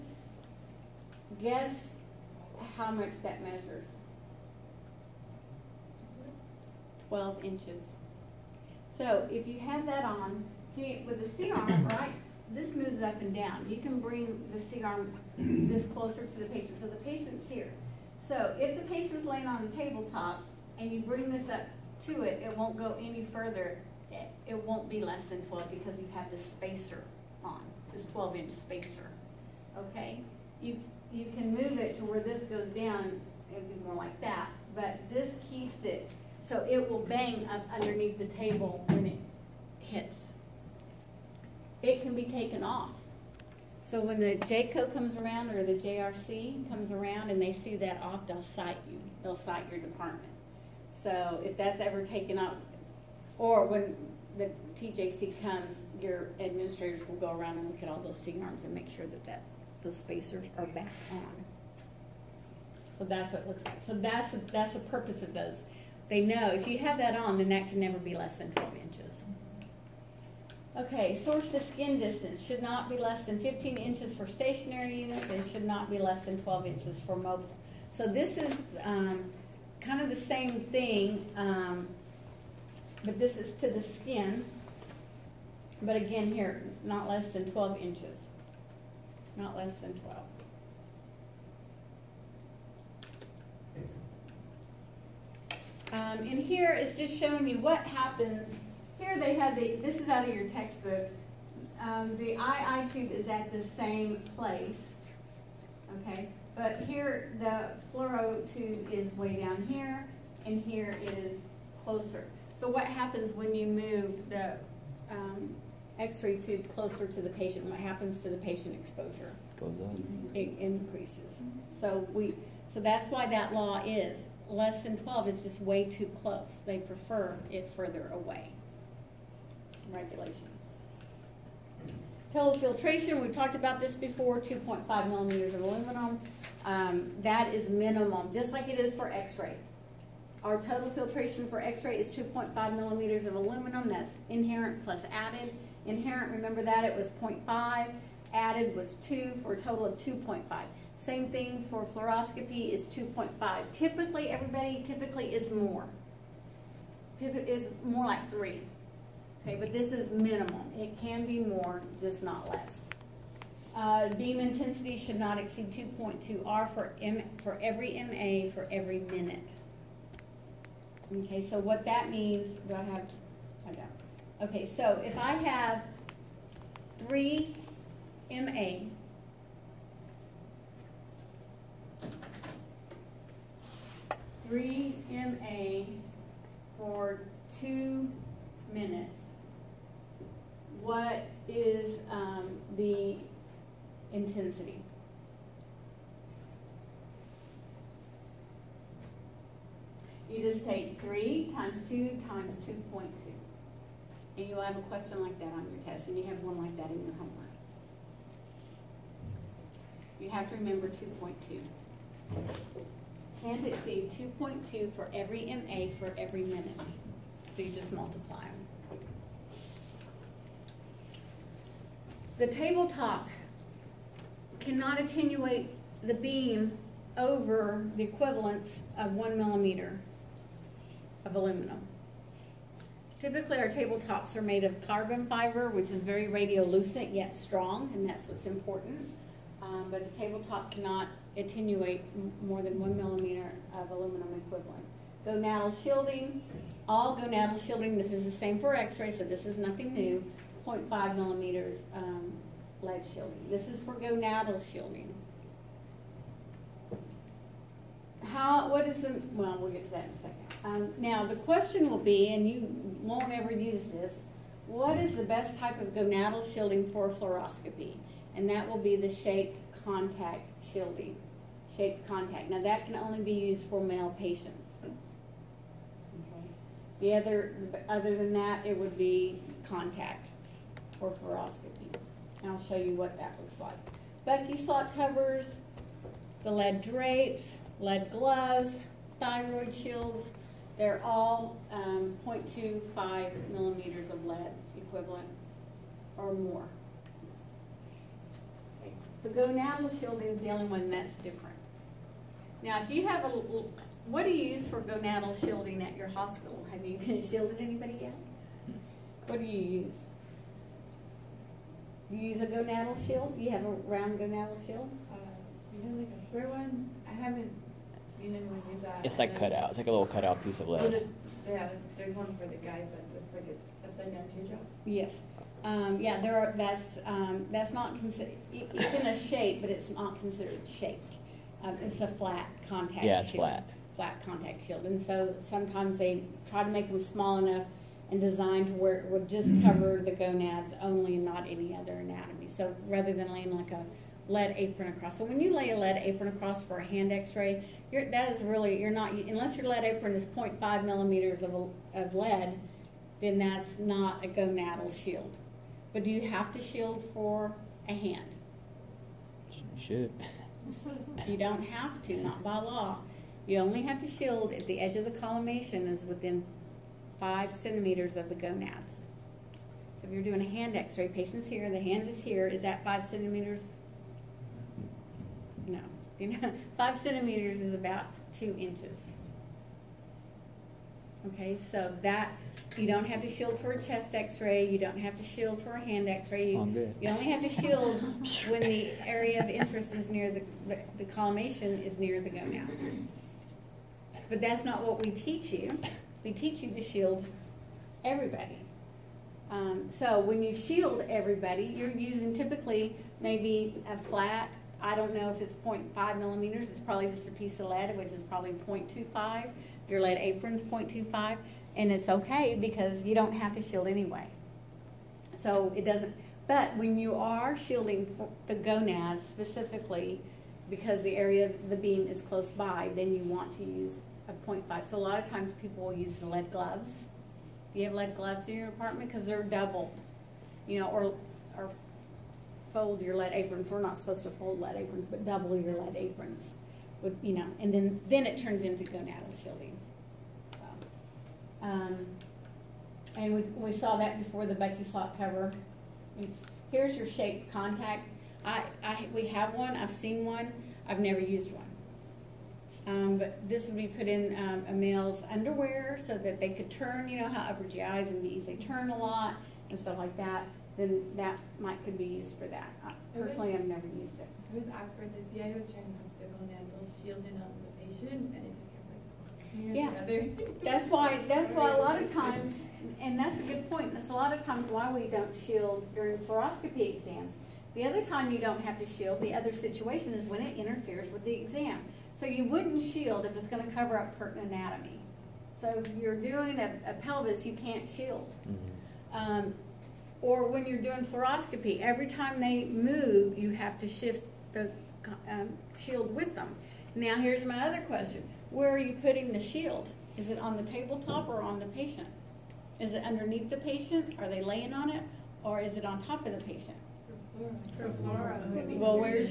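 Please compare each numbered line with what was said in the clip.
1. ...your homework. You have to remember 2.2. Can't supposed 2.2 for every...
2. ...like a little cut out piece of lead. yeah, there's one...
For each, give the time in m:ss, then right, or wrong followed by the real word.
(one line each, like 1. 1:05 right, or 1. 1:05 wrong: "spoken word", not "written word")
1. 3:27 wrong: "exceed", not "supposed"
2. 5:19 right.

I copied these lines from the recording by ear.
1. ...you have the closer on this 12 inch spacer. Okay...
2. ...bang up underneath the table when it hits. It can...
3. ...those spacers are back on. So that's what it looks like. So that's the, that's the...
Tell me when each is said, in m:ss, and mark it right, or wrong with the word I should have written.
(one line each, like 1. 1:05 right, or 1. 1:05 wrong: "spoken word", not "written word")
1. 0:25 wrong: "spacer", not "closer"
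2. 0:37 right
3. 0:59 right.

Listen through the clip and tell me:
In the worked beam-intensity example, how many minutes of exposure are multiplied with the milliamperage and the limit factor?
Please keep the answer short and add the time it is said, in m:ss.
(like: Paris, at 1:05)
2 minutes, at 3:07.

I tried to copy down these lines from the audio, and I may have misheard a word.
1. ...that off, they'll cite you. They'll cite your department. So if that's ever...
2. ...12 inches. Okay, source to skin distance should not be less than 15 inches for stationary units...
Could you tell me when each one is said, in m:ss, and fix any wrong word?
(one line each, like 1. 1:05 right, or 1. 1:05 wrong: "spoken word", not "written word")
1. 0:47 right
2. 1:08 right.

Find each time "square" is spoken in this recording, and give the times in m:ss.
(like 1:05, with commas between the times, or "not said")
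5:16.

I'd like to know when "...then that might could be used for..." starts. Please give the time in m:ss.
7:40.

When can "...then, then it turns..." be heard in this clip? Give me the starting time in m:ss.
7:17.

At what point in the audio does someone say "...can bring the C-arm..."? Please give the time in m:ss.
0:13.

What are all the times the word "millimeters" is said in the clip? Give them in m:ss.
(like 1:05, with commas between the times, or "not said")
2:15, 2:22, 3:49, 4:02, 4:11, 4:53, 5:50, 6:46.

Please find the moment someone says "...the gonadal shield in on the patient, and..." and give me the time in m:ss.
7:46.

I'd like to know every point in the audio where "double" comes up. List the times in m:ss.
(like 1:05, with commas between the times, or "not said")
7:09, 7:15.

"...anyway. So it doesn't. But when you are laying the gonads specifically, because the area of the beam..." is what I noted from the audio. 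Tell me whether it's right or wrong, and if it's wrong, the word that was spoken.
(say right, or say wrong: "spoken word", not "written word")
wrong: "shielding", not "laying".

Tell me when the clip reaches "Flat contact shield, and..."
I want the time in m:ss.
5:33.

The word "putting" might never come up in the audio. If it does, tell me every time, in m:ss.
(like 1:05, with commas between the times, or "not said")
8:19.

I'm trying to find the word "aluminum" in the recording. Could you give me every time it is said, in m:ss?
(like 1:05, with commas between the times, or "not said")
2:15, 2:23, 3:51, 4:03.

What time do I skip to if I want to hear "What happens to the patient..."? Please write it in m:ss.
1:57.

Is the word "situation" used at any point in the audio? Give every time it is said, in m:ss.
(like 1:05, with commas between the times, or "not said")
7:59.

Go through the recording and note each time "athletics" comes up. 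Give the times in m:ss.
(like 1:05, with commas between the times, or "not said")
not said.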